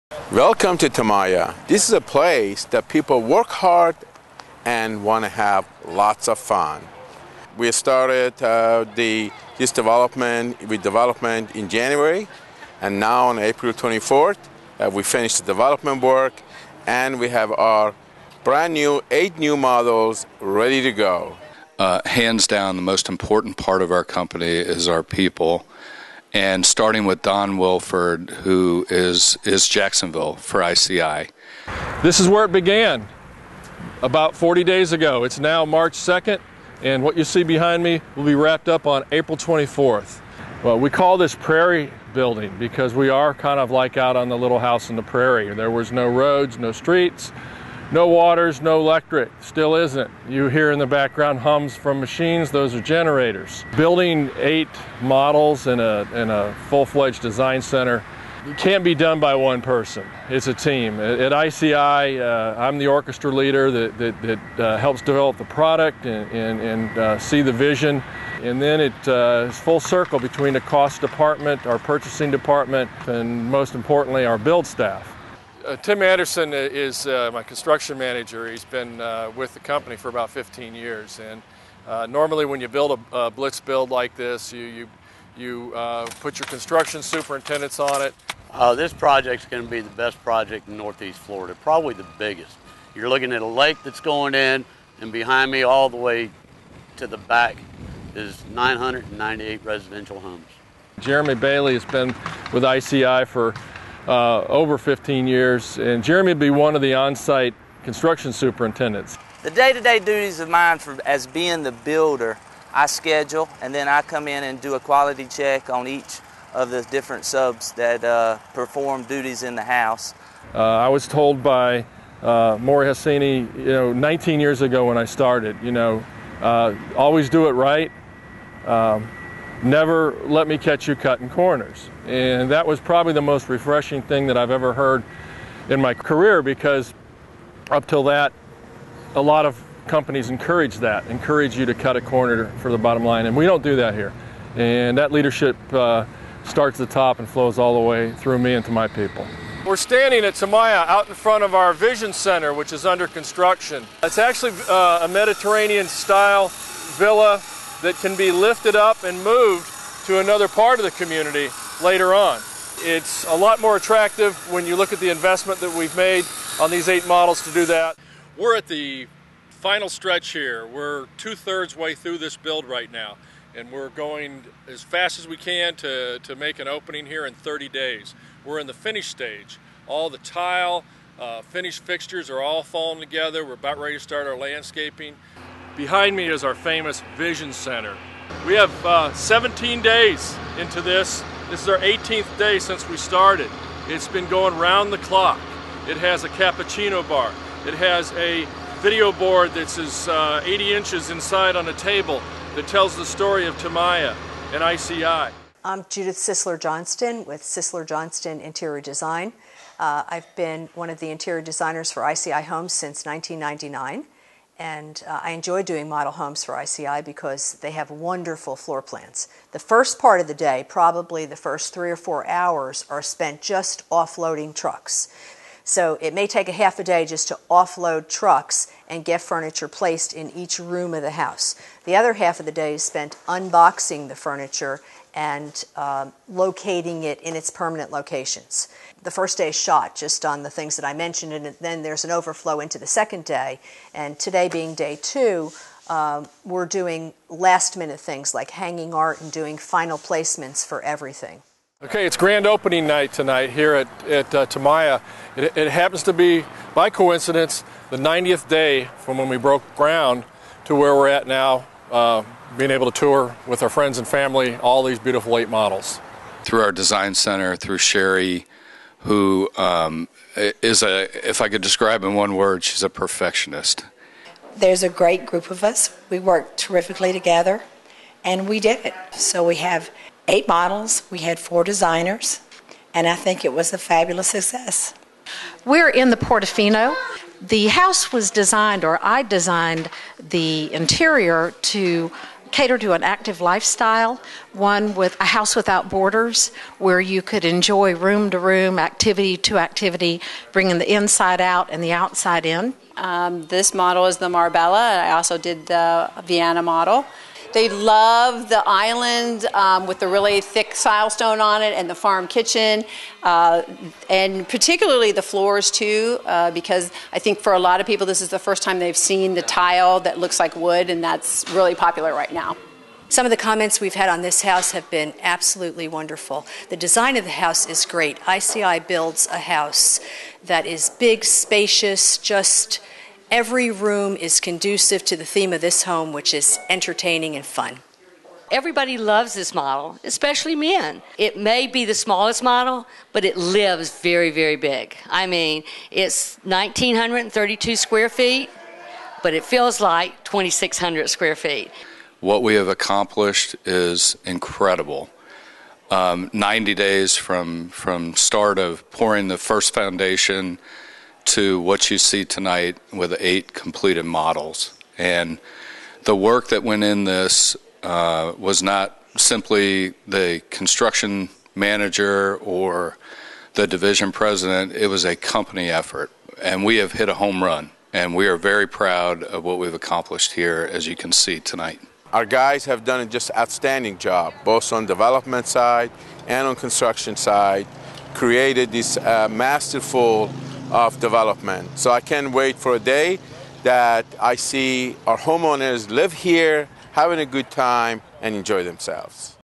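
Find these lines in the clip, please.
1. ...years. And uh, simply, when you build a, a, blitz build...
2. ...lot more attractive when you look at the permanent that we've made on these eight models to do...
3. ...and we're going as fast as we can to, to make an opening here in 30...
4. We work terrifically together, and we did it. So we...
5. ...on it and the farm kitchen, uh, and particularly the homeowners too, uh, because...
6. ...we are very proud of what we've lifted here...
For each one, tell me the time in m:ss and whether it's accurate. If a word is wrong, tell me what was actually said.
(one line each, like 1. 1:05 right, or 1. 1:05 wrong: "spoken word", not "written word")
1. 1:20 wrong: "normally", not "simply"
2. 2:43 wrong: "investment", not "permanent"
3. 2:53 right
4. 4:36 right
5. 5:11 wrong: "floors", not "homeowners"
6. 6:18 wrong: "accomplished", not "lifted".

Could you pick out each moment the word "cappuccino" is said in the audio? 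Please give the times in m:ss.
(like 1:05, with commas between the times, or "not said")
3:16.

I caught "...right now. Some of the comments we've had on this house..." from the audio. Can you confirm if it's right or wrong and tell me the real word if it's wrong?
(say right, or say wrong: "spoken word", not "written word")
right.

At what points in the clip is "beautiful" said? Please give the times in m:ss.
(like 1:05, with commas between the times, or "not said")
4:24.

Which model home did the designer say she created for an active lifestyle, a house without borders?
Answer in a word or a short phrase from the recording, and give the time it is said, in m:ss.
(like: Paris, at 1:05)
Portofino, at 4:46.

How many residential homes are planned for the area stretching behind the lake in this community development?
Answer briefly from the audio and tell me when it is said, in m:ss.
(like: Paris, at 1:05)
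998, at 1:38.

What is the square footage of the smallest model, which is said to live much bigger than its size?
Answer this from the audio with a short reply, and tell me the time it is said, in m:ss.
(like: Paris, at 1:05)
1,932 square feet, at 5:46.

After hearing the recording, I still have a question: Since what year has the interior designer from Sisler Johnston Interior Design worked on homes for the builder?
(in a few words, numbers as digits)
1999.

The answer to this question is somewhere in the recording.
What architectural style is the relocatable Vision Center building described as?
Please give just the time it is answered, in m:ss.
2:35.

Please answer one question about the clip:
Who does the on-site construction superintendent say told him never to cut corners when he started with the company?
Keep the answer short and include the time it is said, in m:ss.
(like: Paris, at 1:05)
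Mori Hosseini, at 2:02.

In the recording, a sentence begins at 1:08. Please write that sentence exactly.
And then it's uh, full circle between the cost department, our purchasing department, and most importantly, our build staff.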